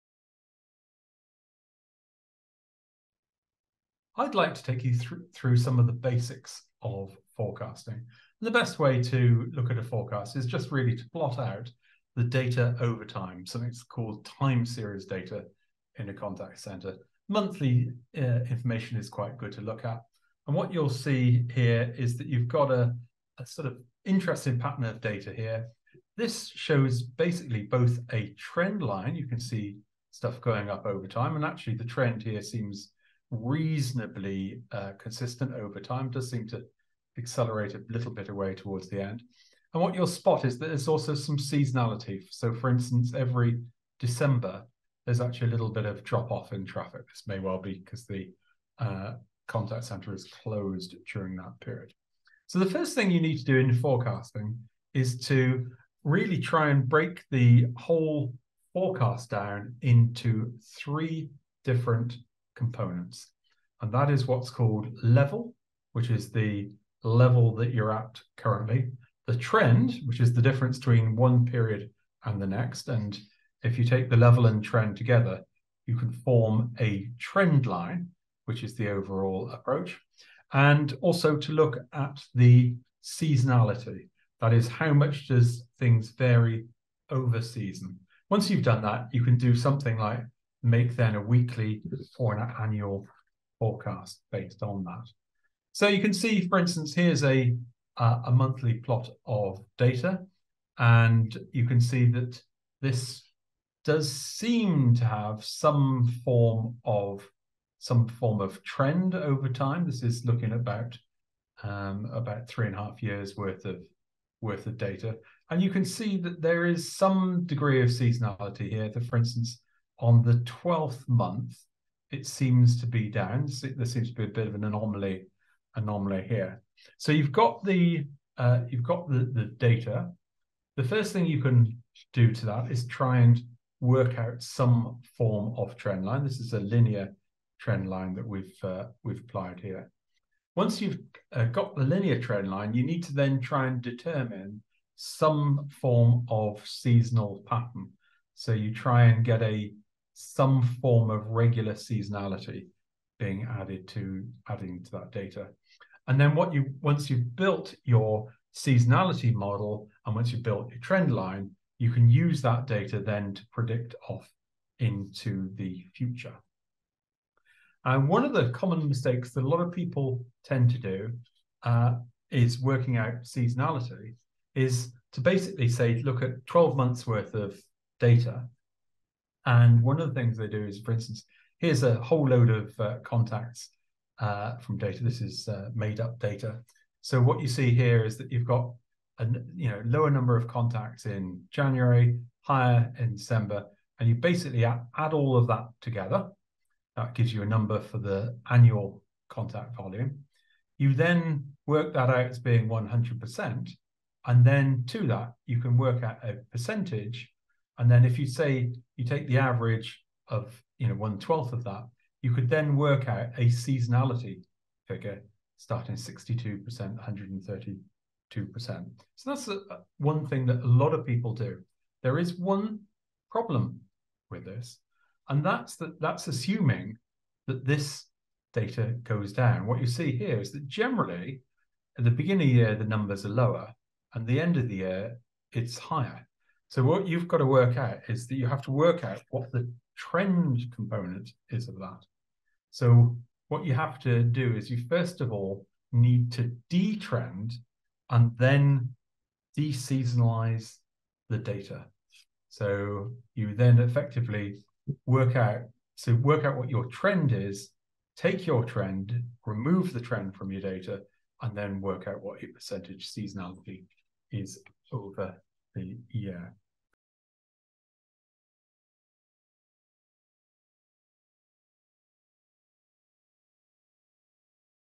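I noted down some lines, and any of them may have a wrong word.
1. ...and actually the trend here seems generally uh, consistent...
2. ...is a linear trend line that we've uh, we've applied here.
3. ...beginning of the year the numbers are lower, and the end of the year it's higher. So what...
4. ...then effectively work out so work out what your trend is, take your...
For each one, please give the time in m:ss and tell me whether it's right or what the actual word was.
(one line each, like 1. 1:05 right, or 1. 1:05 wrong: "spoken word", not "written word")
1. 0:31 wrong: "reasonably", not "generally"
2. 2:16 right
3. 3:52 right
4. 4:13 right.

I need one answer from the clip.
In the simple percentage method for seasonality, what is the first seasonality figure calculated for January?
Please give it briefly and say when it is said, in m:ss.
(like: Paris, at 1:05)
62%, at 3:35.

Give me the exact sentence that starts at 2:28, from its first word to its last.
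So you try and get a some form of regular seasonality being added to adding to that data.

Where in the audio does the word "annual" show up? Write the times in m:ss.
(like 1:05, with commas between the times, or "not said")
1:32, 3:18.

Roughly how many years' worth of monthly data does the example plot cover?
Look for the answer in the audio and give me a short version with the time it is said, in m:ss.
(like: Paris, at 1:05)
3.5 years, at 1:52.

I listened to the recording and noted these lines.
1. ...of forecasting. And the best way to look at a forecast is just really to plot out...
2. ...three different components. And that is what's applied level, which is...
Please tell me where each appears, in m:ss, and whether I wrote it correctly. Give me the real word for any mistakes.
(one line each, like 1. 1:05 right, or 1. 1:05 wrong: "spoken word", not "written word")
1. 0:06 right
2. 1:00 wrong: "called", not "applied".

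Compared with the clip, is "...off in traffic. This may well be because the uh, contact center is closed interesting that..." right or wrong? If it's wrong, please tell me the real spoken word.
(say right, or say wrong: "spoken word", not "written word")
wrong: "during", not "interesting".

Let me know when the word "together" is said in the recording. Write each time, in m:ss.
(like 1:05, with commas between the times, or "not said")
1:14, 3:15.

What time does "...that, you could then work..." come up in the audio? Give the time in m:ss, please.
3:31.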